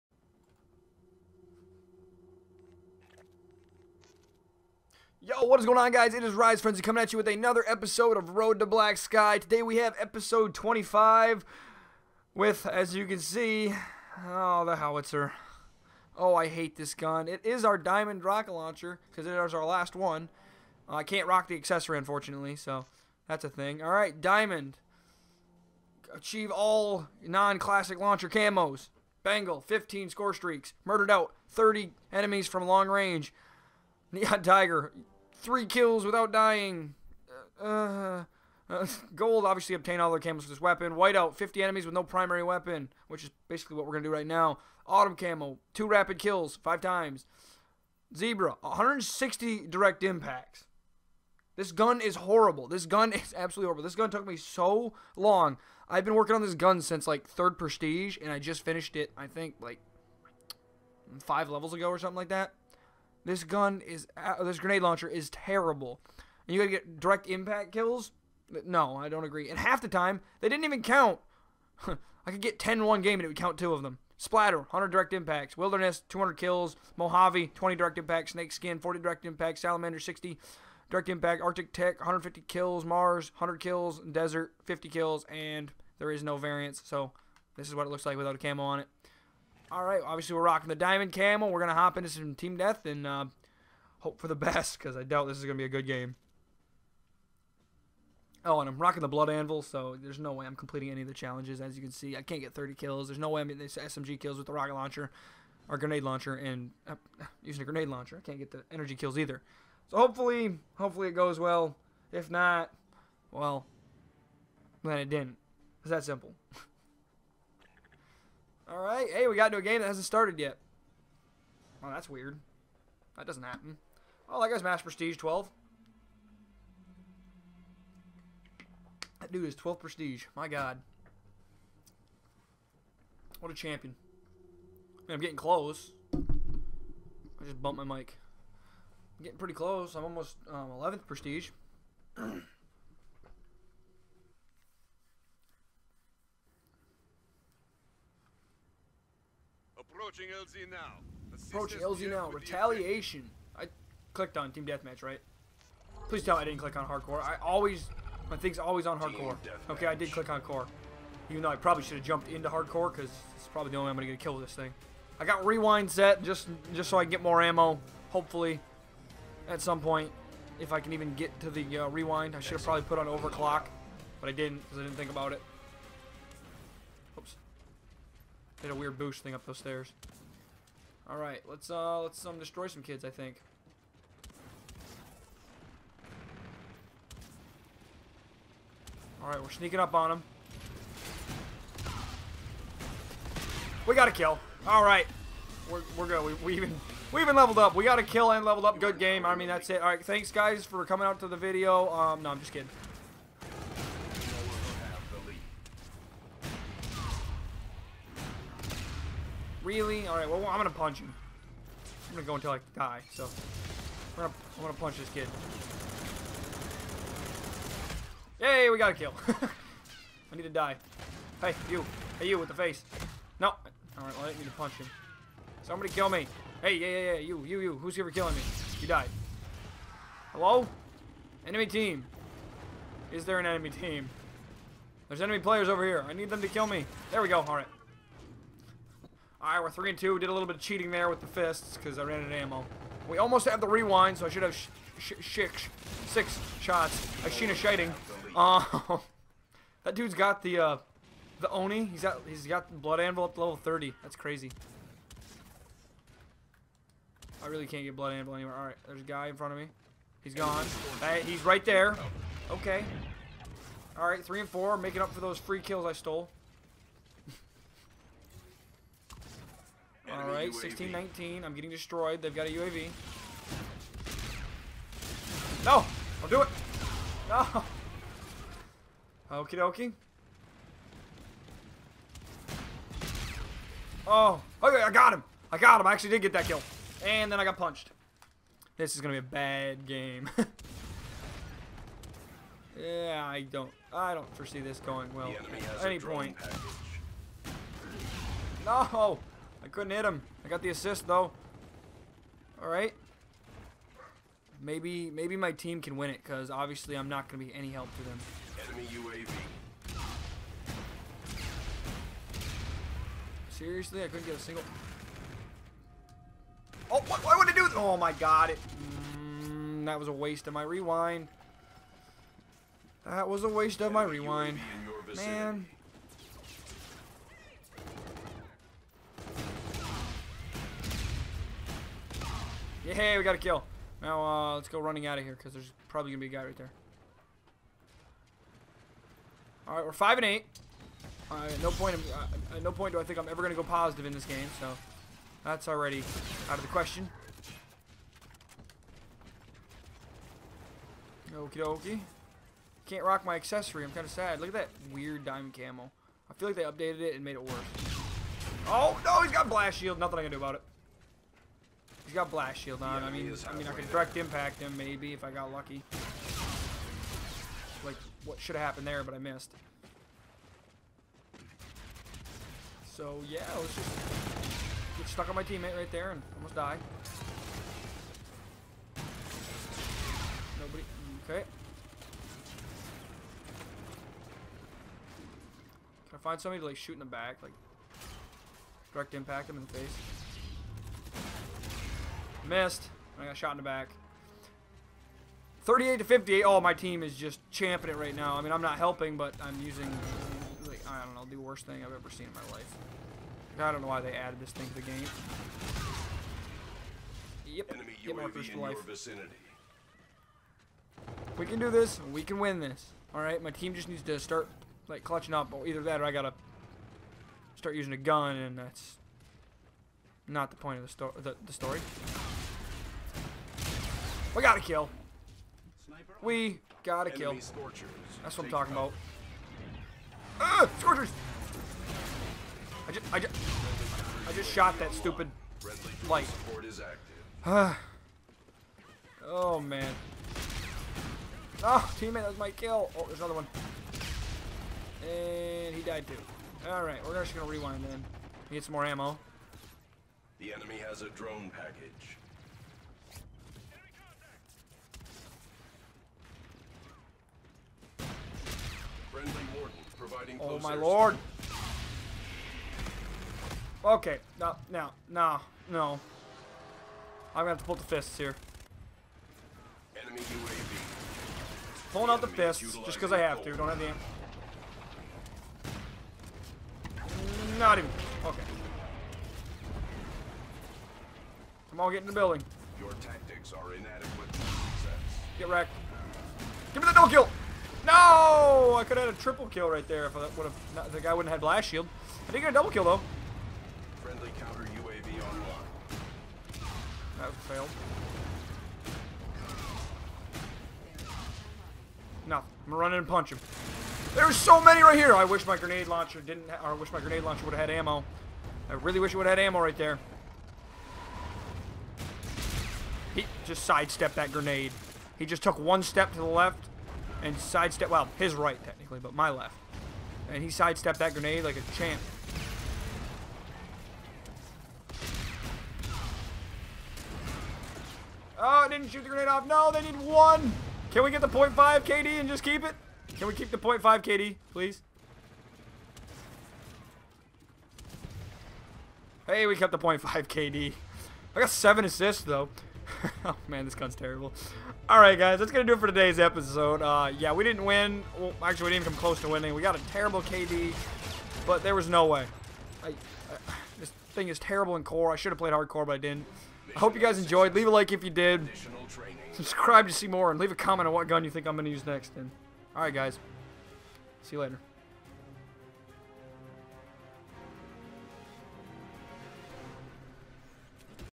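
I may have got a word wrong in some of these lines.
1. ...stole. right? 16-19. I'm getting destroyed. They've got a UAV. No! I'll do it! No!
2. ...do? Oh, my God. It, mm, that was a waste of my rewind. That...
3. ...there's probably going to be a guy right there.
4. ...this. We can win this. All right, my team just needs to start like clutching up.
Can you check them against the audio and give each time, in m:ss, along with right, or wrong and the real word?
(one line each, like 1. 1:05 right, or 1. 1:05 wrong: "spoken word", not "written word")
1. 4:25 right
2. 5:17 right
3. 5:35 right
4. 6:51 right.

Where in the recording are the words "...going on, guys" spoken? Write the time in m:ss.
0:05.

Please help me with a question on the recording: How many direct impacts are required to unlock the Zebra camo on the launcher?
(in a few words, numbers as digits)
160.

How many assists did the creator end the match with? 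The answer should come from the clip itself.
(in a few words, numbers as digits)
7.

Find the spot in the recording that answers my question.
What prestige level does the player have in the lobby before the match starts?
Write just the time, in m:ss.
2:04.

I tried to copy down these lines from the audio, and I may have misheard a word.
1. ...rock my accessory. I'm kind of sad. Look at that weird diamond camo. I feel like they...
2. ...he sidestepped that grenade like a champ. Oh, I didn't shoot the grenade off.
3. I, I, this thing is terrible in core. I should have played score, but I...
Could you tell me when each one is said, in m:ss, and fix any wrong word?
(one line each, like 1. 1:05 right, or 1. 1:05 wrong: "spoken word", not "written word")
1. 5:53 right
2. 8:40 right
3. 9:12 wrong: "hardcore", not "score".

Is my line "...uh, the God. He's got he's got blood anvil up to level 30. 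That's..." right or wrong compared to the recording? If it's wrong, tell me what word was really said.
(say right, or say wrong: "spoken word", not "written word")
wrong: "Oni", not "God".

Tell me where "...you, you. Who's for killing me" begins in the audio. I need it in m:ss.
3:47.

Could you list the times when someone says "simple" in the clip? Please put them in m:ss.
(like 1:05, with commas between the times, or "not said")
1:56.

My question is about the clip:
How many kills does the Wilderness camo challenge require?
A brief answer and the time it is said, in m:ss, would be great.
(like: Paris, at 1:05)
200, at 1:15.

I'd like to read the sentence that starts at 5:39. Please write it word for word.
All right, we're 5 and 8.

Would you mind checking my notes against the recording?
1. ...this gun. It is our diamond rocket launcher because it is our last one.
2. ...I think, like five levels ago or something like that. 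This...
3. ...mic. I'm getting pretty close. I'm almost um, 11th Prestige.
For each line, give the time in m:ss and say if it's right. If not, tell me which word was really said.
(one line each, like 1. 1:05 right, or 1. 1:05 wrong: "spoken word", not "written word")
1. 0:16 right
2. 0:59 right
3. 2:17 right.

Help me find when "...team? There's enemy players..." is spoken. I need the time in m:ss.
3:53.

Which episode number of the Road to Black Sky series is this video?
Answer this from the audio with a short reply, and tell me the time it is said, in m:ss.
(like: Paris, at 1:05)
25, at 0:09.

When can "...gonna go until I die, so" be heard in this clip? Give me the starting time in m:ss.
3:32.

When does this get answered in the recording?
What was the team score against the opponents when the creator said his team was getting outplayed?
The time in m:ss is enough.
6:35.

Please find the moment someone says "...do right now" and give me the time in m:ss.
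0:44.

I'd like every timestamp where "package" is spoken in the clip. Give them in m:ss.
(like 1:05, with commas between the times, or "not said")
4:56, 7:31.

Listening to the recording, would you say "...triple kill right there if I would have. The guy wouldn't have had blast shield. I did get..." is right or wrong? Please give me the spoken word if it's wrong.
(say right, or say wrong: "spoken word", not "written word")
right.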